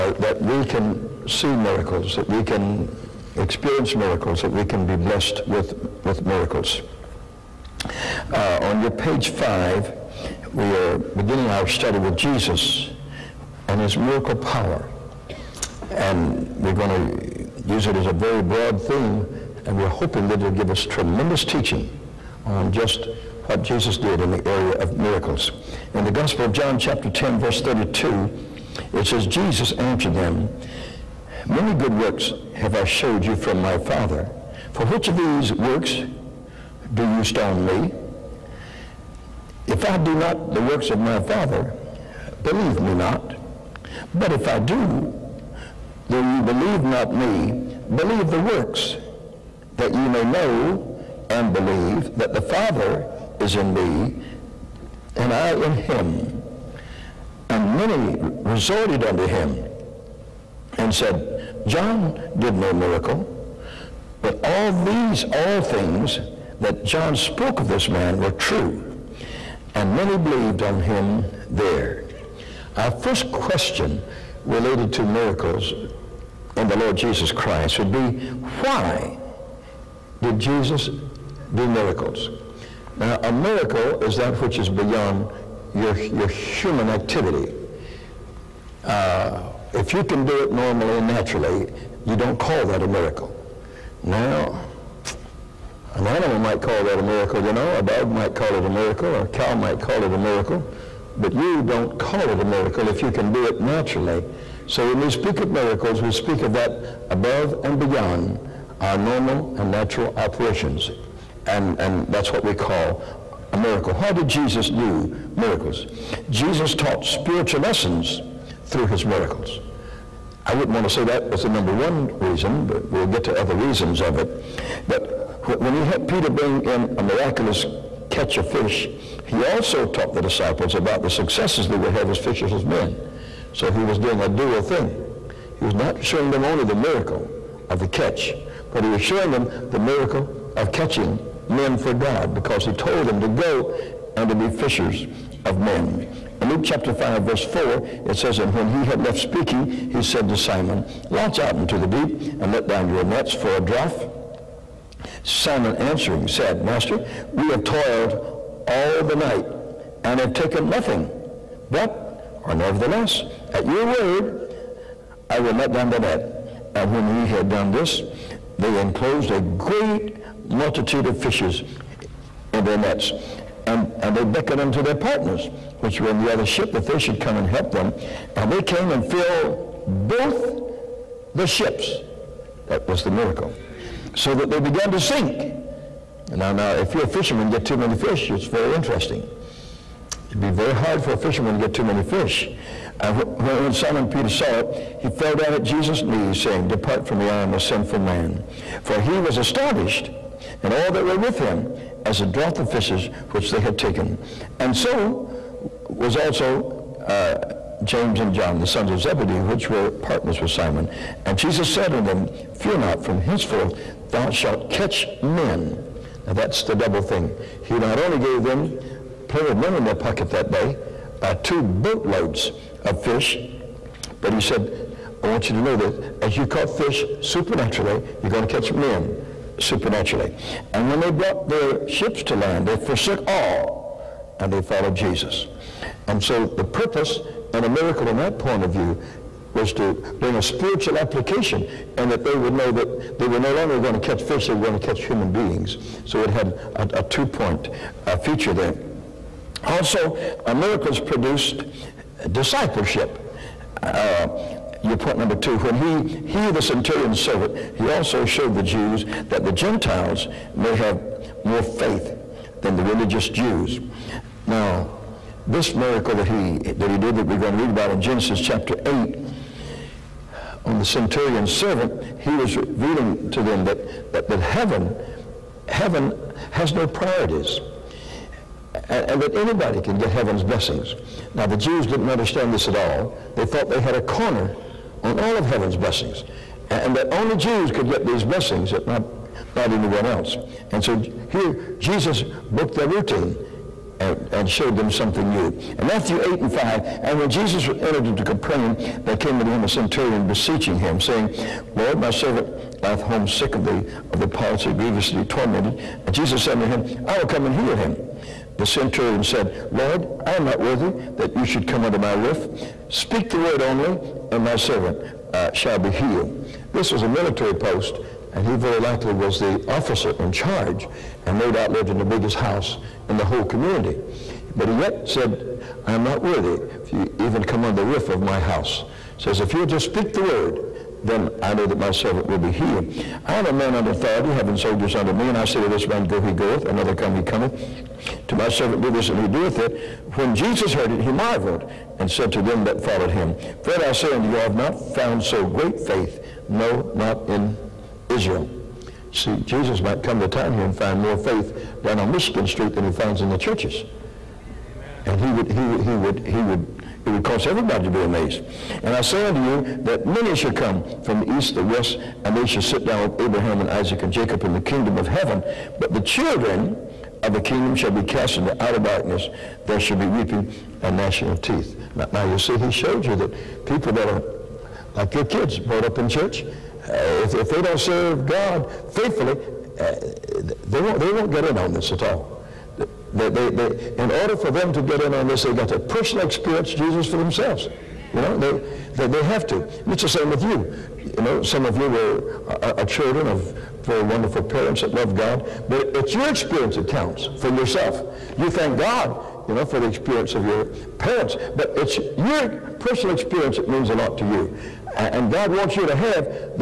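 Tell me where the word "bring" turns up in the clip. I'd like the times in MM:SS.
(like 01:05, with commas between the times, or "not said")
02:06, 04:00.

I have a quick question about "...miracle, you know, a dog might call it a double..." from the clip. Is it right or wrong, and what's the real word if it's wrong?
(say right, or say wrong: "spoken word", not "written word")
wrong: "miracle", not "double".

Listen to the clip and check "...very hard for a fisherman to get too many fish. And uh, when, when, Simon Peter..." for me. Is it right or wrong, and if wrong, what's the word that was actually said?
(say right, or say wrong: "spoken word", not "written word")
right.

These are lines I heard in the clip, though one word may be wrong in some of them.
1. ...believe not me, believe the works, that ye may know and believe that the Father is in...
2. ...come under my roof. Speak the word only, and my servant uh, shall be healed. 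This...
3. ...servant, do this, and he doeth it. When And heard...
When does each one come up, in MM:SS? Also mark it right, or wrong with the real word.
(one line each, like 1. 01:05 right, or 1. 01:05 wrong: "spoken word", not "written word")
1. 00:46 right
2. 05:11 right
3. 05:38 wrong: "Jesus", not "And".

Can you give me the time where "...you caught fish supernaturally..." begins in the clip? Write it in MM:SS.
03:46.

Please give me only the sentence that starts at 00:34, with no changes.
For which of these works do you stone me?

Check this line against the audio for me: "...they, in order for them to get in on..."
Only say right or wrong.
right.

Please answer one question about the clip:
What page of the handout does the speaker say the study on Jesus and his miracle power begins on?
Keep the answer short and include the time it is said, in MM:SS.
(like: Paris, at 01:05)
5, at 00:08.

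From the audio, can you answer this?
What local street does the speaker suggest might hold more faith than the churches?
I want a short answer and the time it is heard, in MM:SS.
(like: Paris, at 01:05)
Michigan Street, at 05:52.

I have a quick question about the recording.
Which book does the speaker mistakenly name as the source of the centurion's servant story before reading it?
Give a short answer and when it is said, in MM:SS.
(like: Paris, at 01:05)
Genesis, at 04:27.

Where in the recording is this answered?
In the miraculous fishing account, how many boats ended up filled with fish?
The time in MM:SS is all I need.
02:59.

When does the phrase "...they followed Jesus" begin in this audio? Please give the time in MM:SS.
03:54.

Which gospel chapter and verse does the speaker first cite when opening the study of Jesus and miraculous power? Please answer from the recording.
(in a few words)
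John 10:32.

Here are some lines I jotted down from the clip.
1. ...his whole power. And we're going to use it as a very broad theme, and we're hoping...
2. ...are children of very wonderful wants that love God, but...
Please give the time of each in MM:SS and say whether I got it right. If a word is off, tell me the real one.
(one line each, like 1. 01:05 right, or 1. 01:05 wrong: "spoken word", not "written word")
1. 00:13 wrong: "miracle", not "whole"
2. 06:32 wrong: "parents", not "wants".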